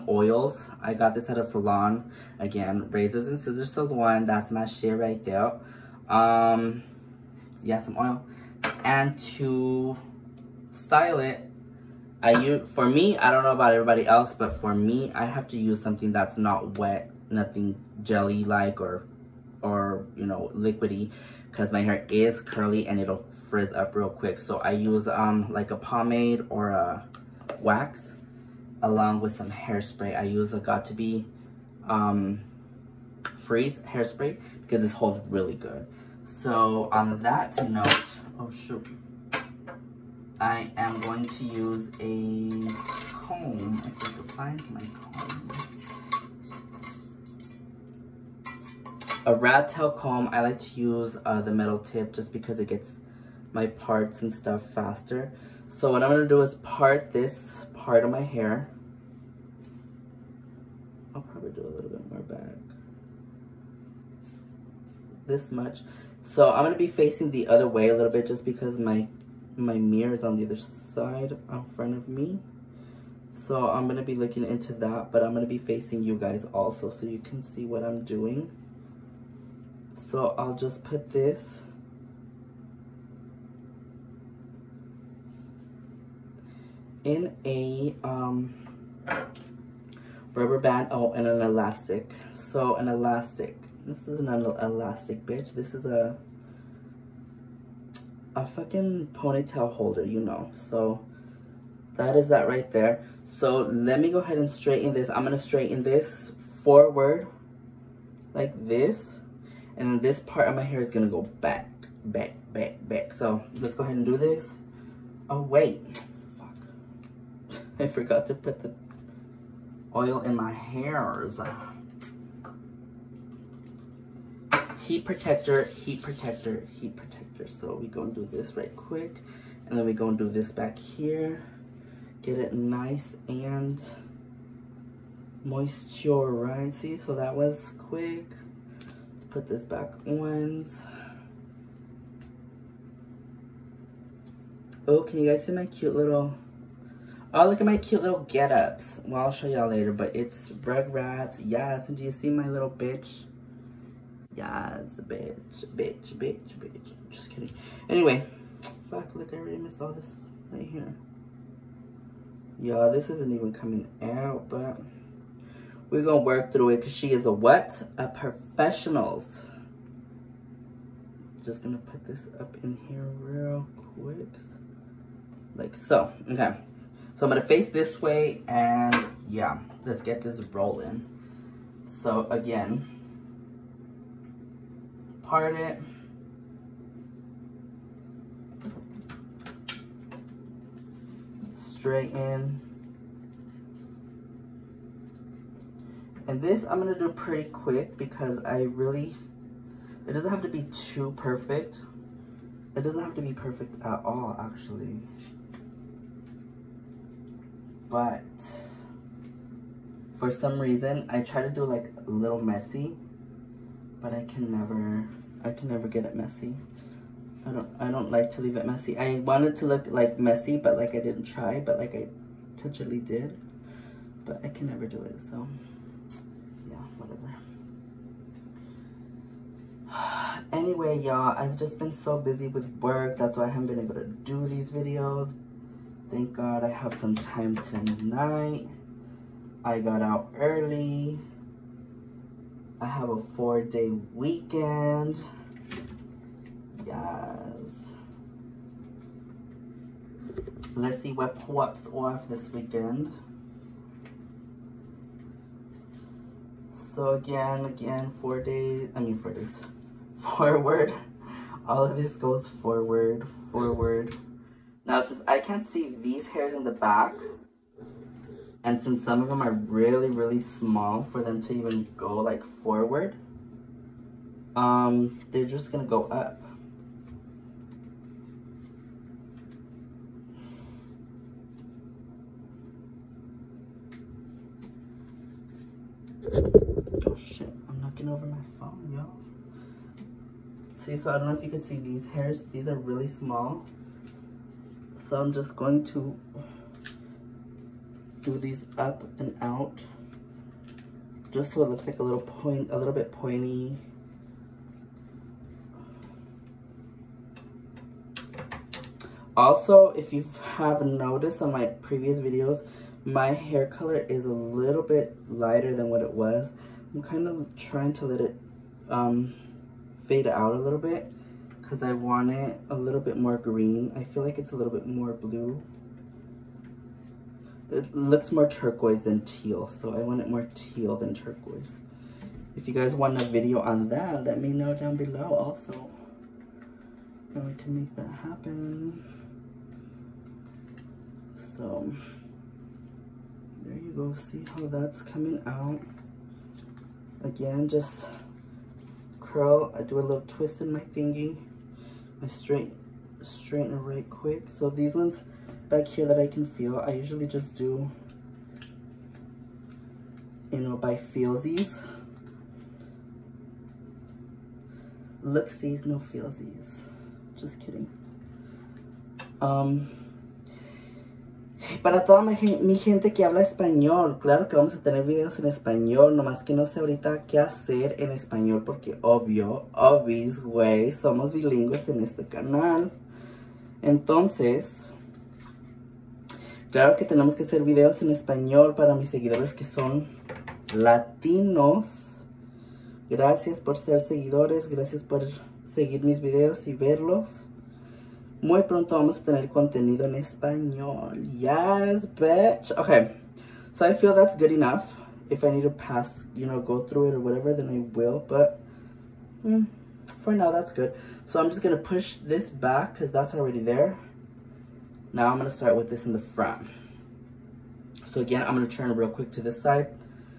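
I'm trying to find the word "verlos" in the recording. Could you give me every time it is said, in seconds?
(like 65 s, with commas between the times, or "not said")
396 s.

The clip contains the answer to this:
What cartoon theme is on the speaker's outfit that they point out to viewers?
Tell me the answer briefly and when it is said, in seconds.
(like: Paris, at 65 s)
Rugrats, at 150 s.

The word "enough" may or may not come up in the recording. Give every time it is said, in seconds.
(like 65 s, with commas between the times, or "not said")
404 s.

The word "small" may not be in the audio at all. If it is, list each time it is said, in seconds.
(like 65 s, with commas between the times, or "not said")
270 s, 293 s.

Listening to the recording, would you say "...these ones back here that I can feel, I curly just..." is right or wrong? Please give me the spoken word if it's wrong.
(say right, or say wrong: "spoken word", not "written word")
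wrong: "usually", not "curly".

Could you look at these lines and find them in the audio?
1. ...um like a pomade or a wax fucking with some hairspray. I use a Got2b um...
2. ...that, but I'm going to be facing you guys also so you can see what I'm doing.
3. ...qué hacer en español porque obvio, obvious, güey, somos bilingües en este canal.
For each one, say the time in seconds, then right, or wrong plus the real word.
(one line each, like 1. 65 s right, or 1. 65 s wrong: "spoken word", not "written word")
1. 25 s wrong: "along", not "fucking"
2. 74 s right
3. 377 s right.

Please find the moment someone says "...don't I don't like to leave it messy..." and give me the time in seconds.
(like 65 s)
217 s.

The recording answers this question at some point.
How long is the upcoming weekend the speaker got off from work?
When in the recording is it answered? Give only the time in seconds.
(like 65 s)
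243 s.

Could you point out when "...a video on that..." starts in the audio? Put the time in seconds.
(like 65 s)
333 s.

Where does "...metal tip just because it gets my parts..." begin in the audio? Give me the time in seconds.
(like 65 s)
51 s.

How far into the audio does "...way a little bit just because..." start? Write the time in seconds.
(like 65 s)
67 s.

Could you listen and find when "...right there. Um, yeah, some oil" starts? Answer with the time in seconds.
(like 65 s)
4 s.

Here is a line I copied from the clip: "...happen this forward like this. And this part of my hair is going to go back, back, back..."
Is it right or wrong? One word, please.
wrong.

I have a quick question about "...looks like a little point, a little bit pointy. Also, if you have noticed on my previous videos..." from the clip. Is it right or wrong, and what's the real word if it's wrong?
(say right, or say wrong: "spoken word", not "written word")
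right.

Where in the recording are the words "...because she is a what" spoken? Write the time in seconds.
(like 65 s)
166 s.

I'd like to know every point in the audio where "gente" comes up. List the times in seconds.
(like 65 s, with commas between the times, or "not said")
372 s.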